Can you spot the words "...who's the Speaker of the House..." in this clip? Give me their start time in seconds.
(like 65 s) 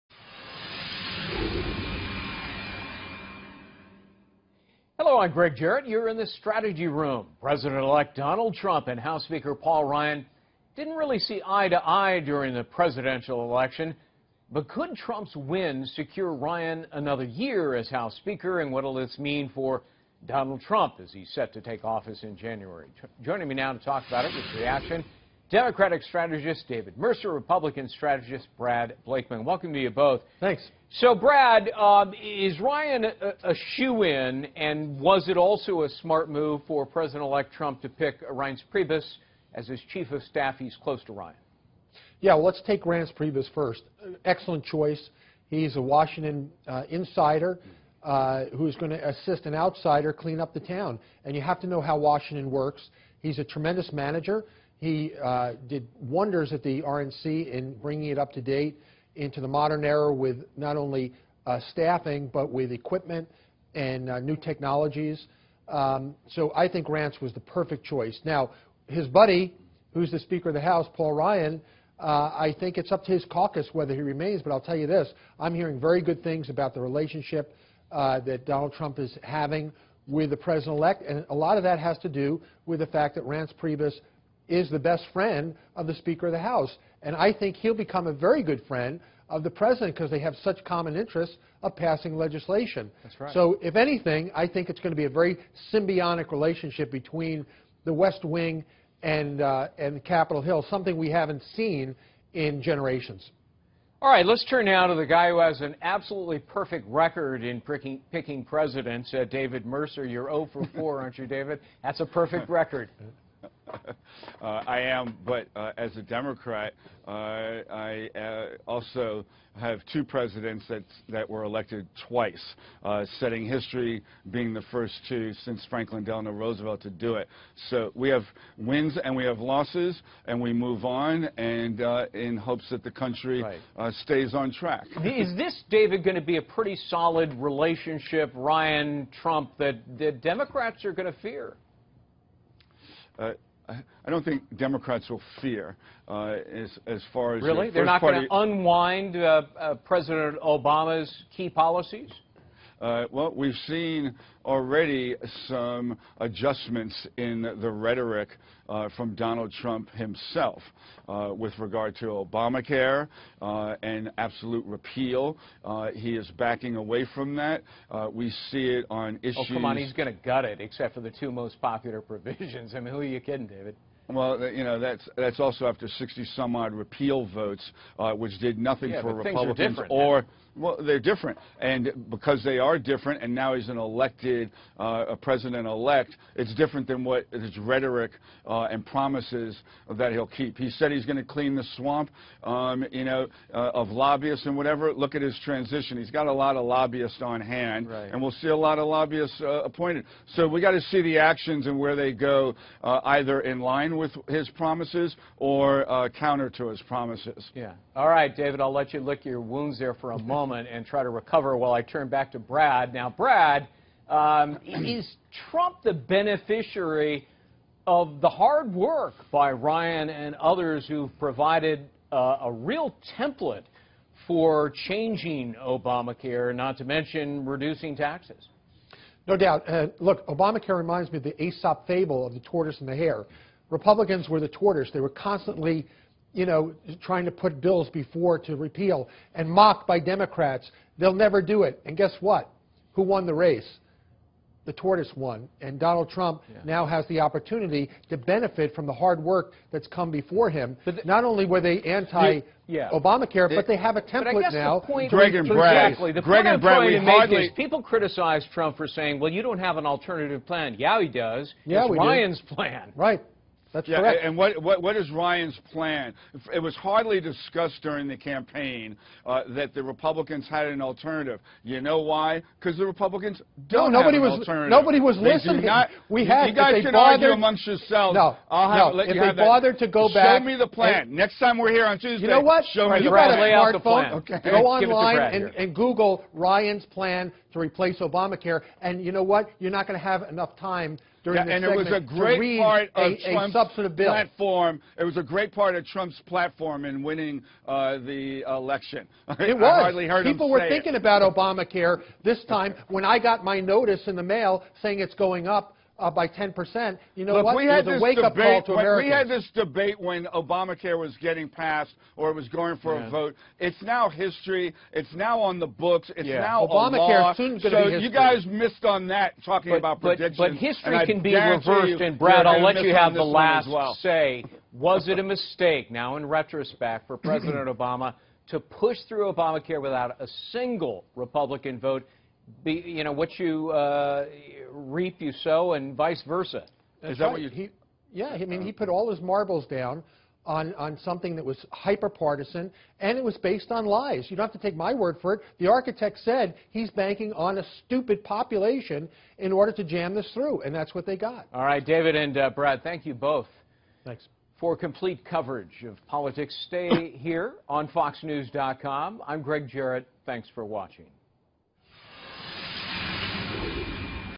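69 s.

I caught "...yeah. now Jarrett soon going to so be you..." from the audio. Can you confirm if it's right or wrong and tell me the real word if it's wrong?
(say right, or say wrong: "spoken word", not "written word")
wrong: "Obamacare", not "Jarrett".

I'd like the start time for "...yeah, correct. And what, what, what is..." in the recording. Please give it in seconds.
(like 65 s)
263 s.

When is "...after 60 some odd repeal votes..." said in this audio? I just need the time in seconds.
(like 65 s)
175 s.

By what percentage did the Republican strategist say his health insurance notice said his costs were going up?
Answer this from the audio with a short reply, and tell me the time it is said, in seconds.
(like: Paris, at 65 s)
10%, at 306 s.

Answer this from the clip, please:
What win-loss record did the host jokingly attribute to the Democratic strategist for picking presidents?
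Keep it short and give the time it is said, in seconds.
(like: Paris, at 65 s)
0 for 4, at 110 s.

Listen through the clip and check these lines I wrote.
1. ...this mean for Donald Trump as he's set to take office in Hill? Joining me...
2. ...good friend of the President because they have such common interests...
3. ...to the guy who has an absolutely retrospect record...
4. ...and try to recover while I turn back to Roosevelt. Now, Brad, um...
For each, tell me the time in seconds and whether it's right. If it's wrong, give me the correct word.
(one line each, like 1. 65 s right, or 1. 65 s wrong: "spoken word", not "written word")
1. 18 s wrong: "January", not "Hill"
2. 88 s right
3. 104 s wrong: "perfect", not "retrospect"
4. 210 s wrong: "Brad", not "Roosevelt".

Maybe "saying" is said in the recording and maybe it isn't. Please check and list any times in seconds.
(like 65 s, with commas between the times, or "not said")
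258 s, 304 s.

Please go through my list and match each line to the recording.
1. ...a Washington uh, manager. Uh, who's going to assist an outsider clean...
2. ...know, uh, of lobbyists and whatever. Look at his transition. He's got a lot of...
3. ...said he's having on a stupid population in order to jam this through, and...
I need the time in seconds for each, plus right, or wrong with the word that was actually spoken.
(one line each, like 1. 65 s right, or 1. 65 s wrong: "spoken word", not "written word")
1. 45 s wrong: "insider", not "manager"
2. 193 s right
3. 346 s wrong: "banking", not "having".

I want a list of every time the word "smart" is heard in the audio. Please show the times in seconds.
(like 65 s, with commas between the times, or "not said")
36 s.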